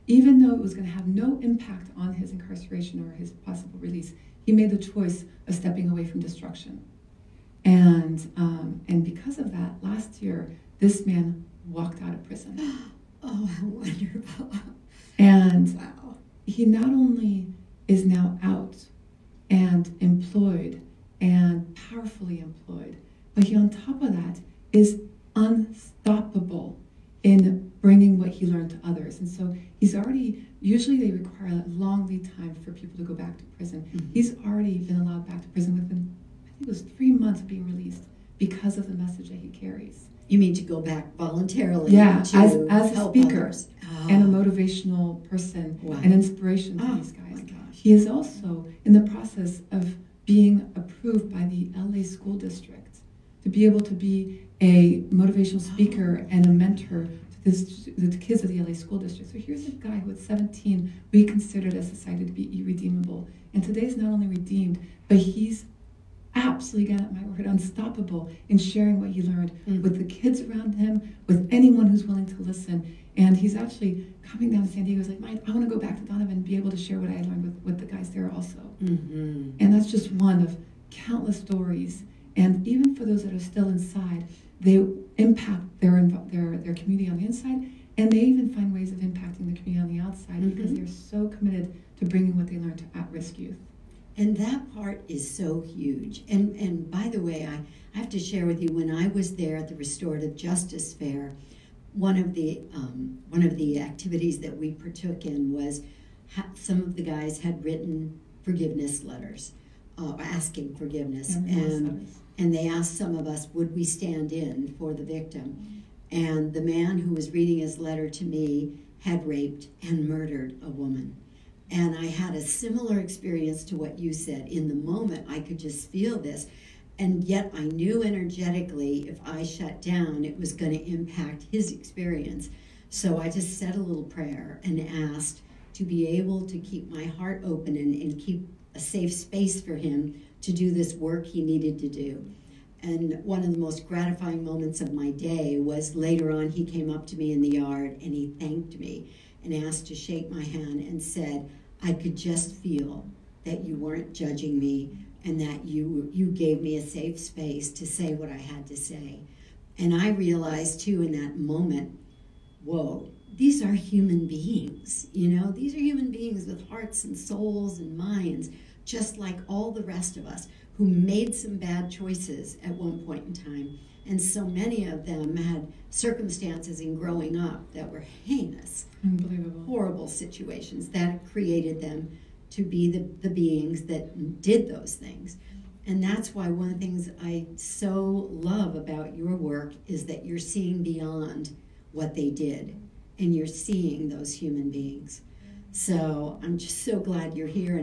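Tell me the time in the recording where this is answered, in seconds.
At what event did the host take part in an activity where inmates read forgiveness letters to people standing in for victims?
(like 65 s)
99 s.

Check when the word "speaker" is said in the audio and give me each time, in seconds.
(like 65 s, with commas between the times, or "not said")
43 s, 55 s.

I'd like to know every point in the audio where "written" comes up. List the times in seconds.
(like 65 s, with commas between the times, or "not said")
107 s.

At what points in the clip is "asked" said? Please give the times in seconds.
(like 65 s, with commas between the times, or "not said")
112 s, 135 s, 149 s.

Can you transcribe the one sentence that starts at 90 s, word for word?
because they're so committed to bringing what they learned to at risk youth.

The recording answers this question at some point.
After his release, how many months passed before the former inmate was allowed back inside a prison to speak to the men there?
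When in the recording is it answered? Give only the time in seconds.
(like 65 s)
36 s.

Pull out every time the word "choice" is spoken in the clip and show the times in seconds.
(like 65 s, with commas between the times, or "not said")
4 s, 171 s.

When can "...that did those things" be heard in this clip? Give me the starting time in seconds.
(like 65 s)
183 s.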